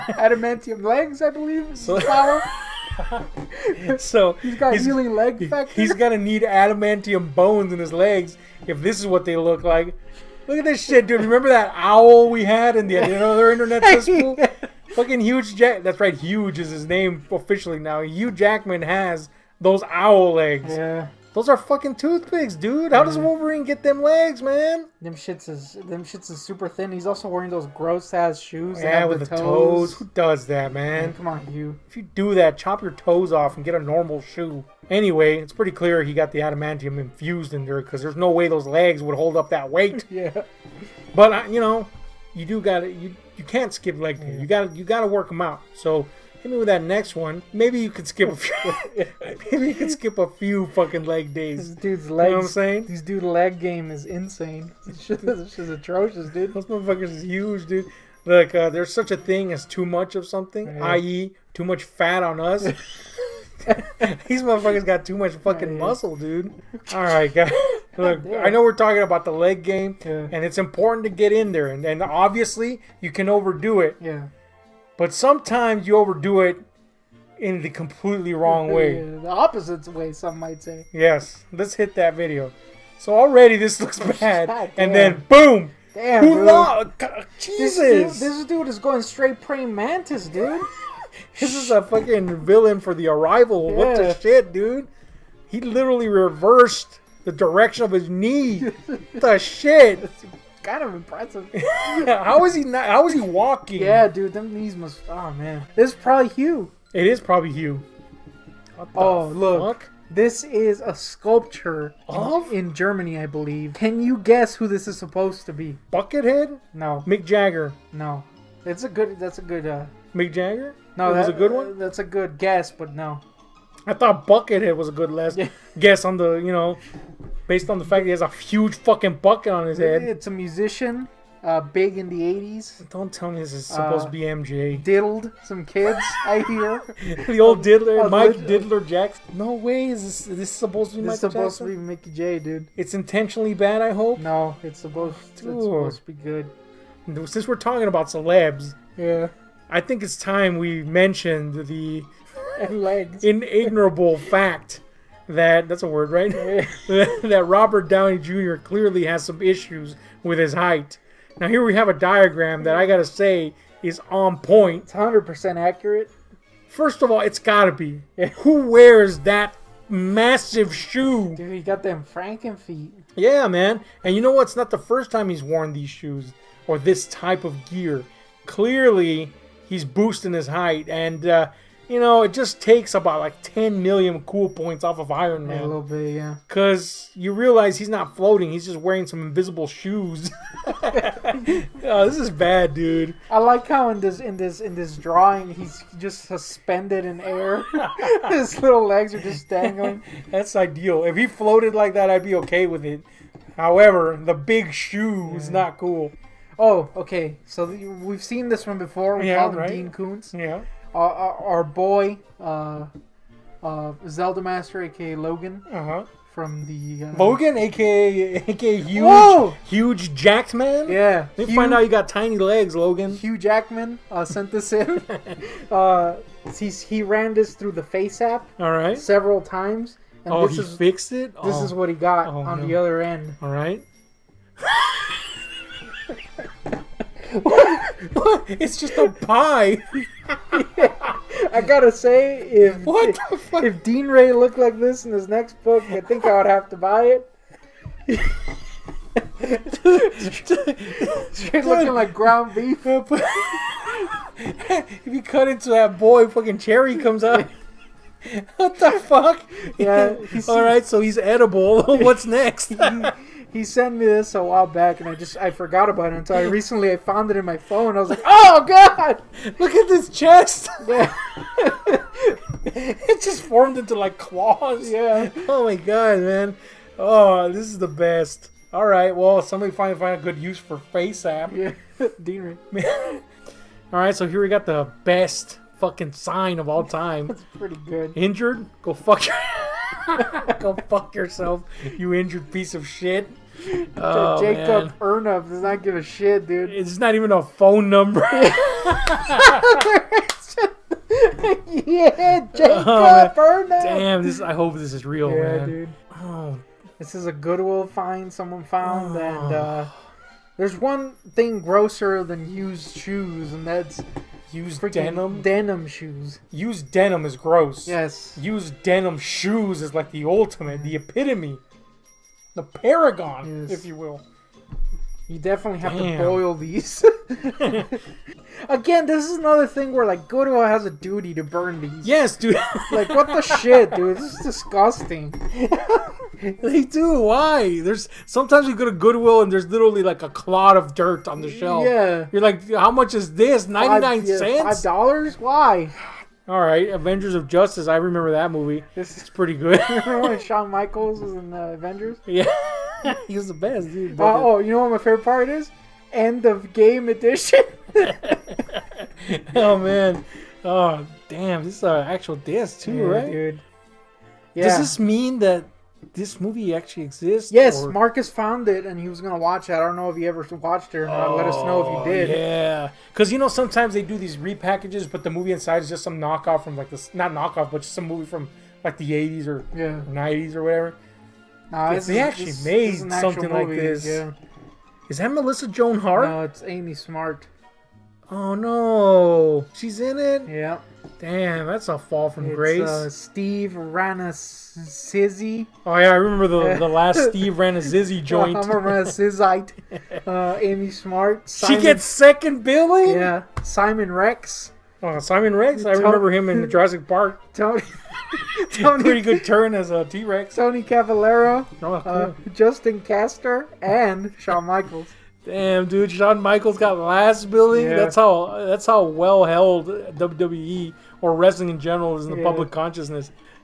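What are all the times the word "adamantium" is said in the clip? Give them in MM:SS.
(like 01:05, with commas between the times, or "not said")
00:00, 00:06, 00:36.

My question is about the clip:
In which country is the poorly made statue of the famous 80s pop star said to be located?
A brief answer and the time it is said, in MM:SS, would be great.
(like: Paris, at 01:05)
Germany, at 01:52.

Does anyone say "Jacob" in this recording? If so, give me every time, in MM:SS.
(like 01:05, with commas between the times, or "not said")
04:54, 05:02.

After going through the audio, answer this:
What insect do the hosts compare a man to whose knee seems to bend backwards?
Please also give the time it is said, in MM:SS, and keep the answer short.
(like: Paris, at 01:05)
Praying mantis, at 01:29.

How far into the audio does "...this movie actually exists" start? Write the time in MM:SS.
06:06.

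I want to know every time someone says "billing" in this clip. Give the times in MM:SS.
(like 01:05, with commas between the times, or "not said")
06:42, 06:57.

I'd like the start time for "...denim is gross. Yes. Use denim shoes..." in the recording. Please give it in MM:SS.
05:16.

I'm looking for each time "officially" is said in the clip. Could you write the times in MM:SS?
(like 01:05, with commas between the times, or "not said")
00:17.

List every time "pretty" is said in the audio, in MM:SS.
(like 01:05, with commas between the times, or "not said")
00:35, 04:47, 05:49, 06:49.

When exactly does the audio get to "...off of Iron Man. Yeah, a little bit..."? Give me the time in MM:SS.
03:04.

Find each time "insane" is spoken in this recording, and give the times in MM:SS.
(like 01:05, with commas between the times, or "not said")
00:54.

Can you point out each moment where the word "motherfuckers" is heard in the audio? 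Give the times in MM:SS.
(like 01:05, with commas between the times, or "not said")
00:56, 01:04.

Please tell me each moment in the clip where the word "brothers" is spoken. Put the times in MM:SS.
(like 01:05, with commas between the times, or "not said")
not said.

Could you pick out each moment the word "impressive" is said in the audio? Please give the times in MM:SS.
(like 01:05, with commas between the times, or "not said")
01:40.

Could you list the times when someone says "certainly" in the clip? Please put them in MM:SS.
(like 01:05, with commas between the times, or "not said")
not said.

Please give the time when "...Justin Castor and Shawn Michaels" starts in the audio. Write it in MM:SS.
06:52.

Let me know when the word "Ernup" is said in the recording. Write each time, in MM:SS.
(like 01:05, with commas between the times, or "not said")
04:54, 05:03.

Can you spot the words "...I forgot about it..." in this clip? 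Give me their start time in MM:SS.
04:25.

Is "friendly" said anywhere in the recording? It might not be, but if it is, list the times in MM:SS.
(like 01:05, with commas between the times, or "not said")
not said.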